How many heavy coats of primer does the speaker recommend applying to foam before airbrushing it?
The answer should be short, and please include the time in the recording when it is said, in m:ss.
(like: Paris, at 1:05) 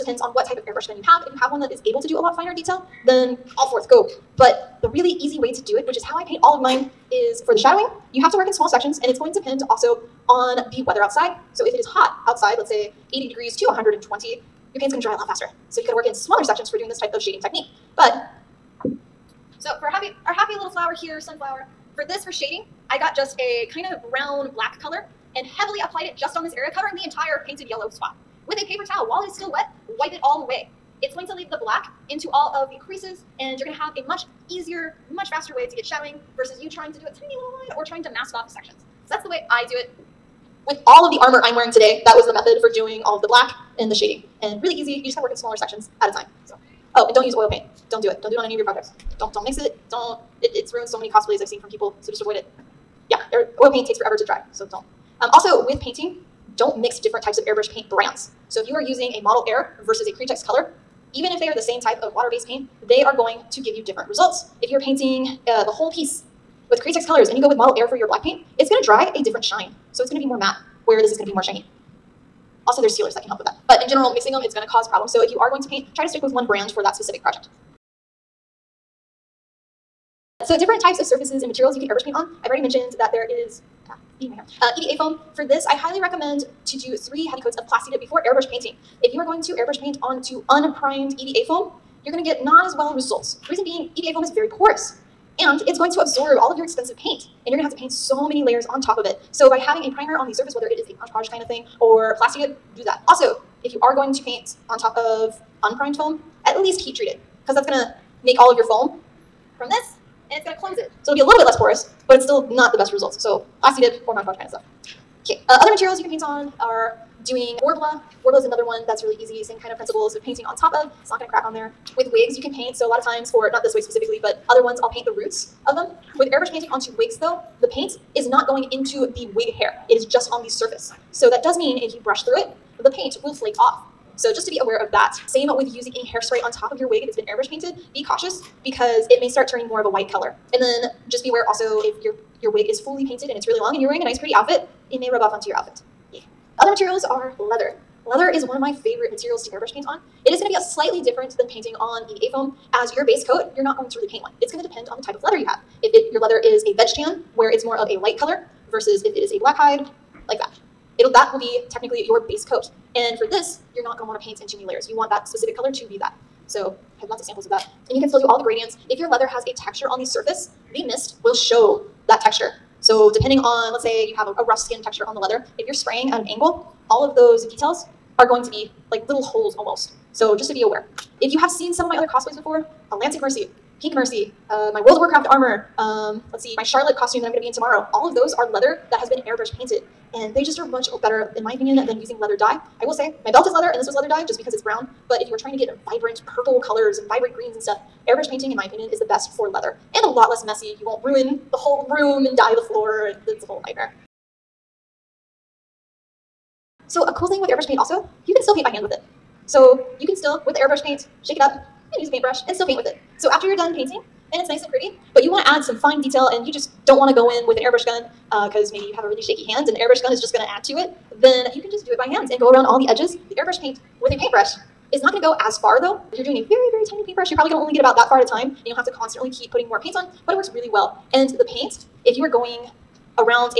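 3, at 1:26.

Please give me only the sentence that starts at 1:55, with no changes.
Okay, uh, other materials you can paint on are doing Worbla.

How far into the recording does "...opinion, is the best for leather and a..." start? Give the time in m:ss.
3:18.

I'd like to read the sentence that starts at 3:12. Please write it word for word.
I will say my belt is leather and this was leather dye just because it's brown.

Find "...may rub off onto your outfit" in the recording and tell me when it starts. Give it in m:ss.
2:24.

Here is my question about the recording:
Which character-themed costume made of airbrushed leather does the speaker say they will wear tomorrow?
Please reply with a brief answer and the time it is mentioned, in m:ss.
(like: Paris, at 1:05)
Charlotte, at 3:06.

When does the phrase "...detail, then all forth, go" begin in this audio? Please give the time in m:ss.
0:02.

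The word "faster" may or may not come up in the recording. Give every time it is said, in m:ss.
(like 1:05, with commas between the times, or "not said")
0:15, 0:35.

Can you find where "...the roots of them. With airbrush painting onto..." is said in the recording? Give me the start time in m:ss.
2:05.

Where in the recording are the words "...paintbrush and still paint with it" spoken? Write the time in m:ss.
3:32.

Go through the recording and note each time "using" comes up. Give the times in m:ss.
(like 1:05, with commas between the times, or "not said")
0:58, 2:15, 3:12.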